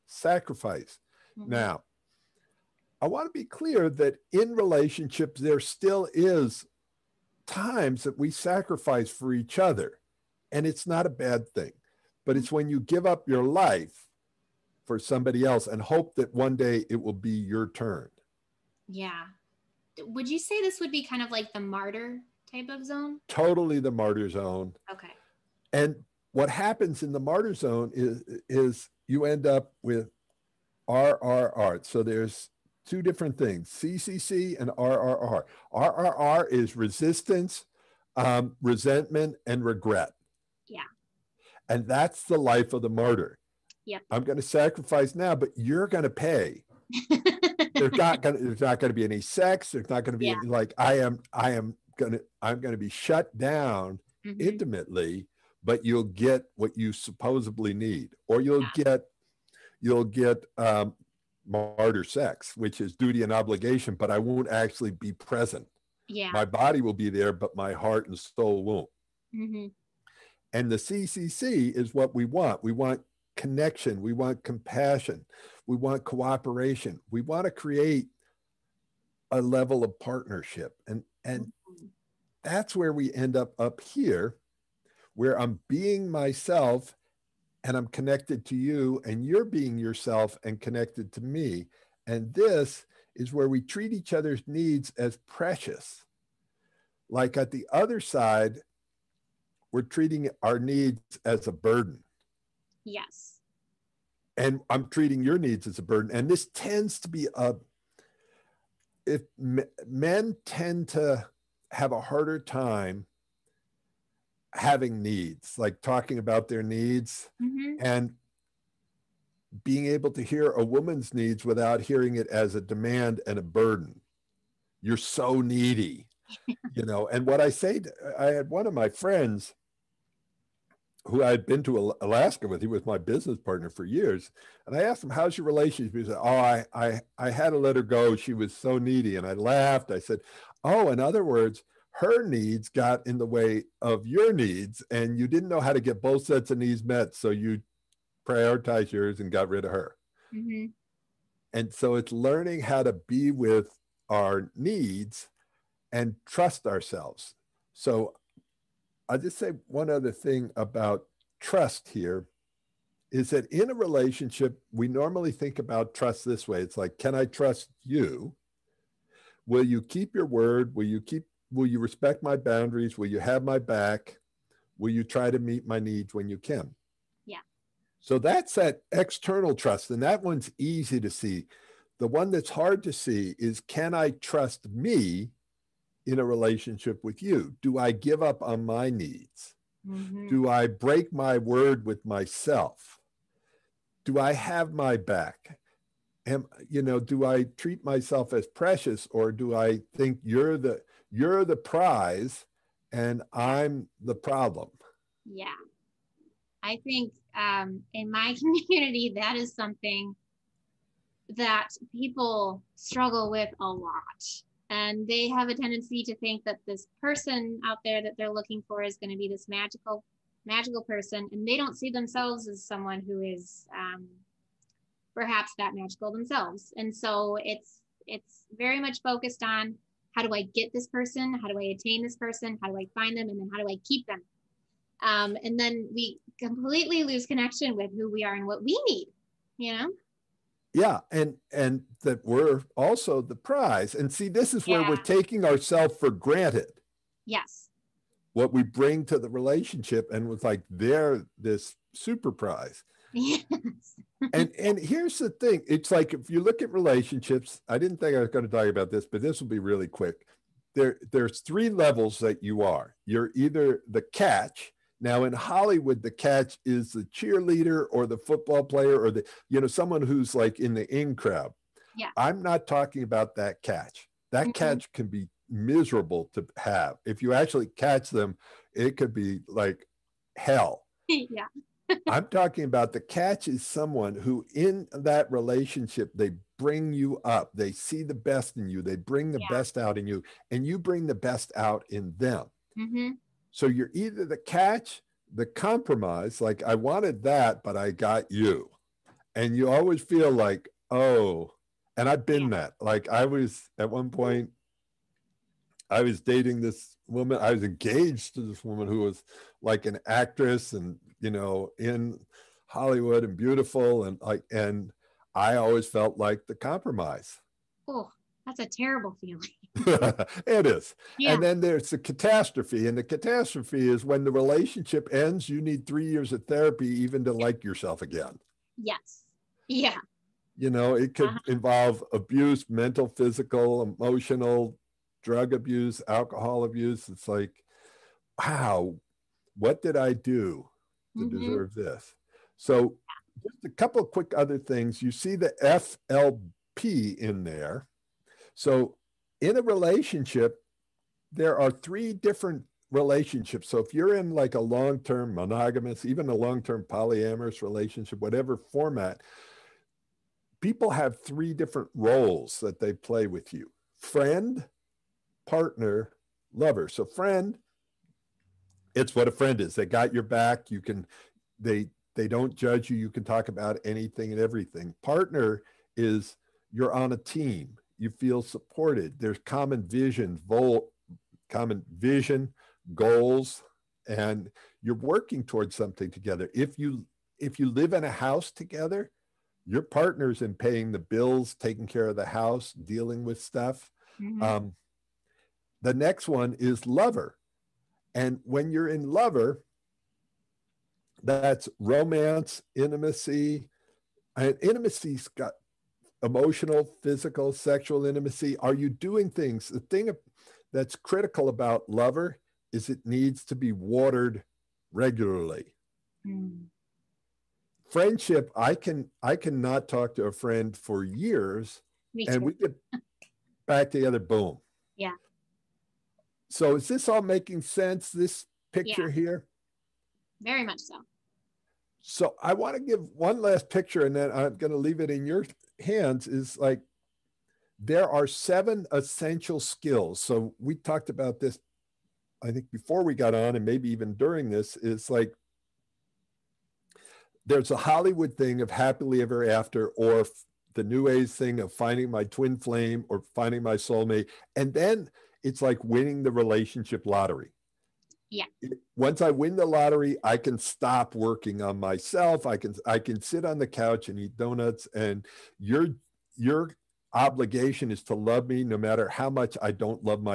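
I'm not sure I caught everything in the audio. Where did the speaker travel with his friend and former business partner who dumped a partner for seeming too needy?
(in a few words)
Alaska.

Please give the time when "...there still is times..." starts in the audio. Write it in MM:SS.
00:05.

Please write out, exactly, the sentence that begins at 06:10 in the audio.
You can, they, they don't judge you.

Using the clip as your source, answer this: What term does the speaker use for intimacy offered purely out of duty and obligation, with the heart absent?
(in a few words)
martyr sex.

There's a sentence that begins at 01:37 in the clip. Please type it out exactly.
Like at the other side, we're treating our needs as a burden.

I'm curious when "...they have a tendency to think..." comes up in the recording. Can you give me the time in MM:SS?
03:35.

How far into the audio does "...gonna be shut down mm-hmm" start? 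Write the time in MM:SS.
00:52.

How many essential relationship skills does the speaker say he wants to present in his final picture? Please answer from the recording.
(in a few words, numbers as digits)
7.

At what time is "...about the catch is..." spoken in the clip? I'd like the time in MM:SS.
04:42.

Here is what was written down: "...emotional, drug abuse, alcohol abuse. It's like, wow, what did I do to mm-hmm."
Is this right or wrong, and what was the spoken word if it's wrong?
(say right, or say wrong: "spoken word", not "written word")
right.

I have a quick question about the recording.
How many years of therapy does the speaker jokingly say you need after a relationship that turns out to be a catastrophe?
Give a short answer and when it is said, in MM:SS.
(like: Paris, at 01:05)
3, at 05:25.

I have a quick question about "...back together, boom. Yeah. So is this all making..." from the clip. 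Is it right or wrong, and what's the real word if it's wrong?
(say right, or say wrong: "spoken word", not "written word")
right.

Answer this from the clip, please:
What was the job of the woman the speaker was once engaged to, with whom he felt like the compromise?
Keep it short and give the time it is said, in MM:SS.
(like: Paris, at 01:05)
actress, at 05:10.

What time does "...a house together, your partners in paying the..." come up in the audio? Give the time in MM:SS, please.
06:28.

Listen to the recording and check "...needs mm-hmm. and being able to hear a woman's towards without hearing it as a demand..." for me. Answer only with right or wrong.
wrong.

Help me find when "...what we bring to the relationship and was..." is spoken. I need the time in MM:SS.
04:08.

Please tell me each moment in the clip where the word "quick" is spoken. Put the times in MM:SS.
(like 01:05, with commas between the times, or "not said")
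04:19, 05:44.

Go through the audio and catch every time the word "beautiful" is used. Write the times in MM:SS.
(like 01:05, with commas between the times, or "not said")
05:13.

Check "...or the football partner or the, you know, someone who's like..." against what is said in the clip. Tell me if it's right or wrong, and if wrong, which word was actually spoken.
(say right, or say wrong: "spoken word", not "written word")
wrong: "player", not "partner".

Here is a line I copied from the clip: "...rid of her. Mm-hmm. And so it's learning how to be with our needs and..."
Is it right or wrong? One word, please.
right.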